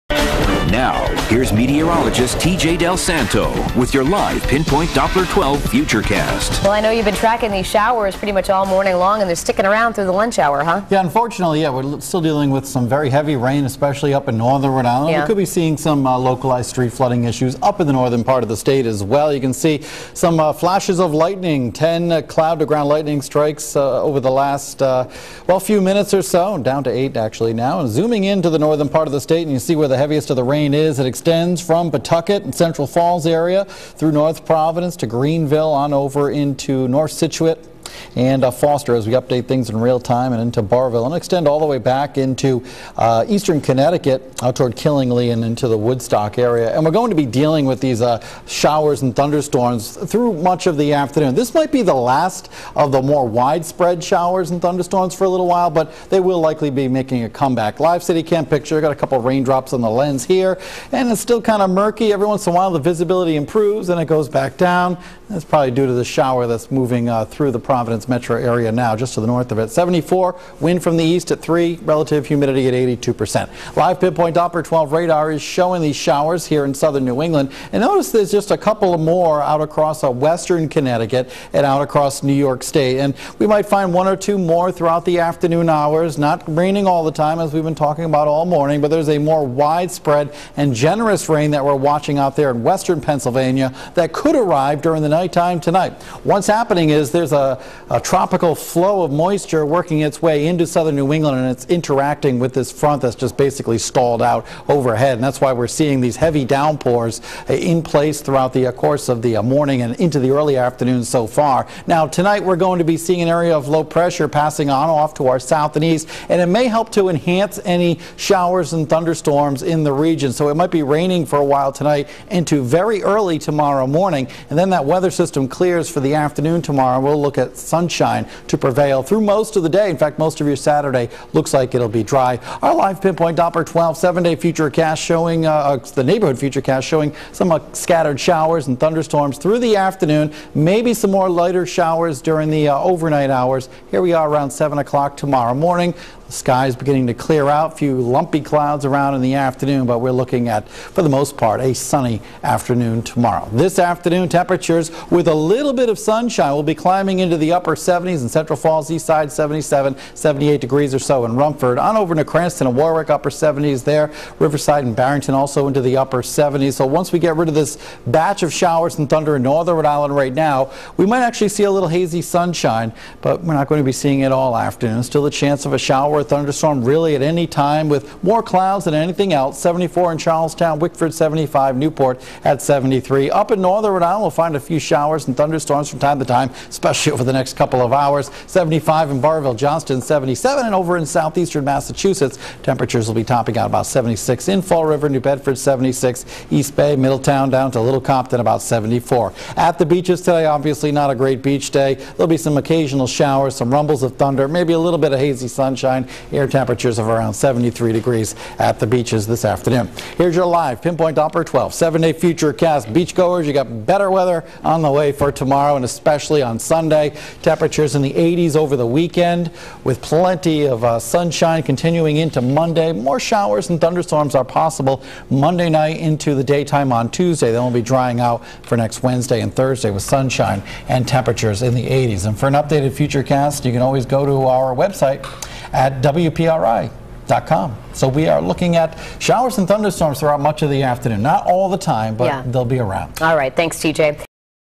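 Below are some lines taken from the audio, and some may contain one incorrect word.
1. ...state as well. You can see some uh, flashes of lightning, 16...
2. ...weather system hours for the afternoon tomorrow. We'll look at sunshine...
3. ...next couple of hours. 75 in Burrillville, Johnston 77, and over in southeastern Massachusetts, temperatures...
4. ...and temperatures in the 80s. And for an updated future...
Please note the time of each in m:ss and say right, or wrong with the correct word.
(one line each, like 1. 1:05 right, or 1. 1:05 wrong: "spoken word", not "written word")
1. 0:18 wrong: "10", not "16"
2. 2:05 wrong: "clears", not "hours"
3. 3:07 right
4. 3:50 right.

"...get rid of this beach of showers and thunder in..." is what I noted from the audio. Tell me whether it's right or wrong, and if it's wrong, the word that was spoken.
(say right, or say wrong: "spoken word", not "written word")
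wrong: "batch", not "beach".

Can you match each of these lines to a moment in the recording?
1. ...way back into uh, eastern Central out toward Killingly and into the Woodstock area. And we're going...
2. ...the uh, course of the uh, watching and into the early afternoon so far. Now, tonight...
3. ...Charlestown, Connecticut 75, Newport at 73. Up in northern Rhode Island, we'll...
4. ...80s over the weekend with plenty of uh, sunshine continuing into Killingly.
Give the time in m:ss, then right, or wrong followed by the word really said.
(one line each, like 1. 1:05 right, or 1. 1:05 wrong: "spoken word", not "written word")
1. 0:41 wrong: "Connecticut", not "Central"
2. 1:48 wrong: "morning", not "watching"
3. 3:00 wrong: "Wickford", not "Connecticut"
4. 3:38 wrong: "Monday", not "Killingly".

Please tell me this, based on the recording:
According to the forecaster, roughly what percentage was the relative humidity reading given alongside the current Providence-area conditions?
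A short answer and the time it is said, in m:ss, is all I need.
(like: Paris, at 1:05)
82%, at 1:12.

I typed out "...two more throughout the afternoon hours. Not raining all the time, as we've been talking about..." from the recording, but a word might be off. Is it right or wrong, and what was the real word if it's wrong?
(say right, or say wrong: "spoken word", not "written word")
right.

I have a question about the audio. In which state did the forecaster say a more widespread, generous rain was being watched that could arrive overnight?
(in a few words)
western Pennsylvania.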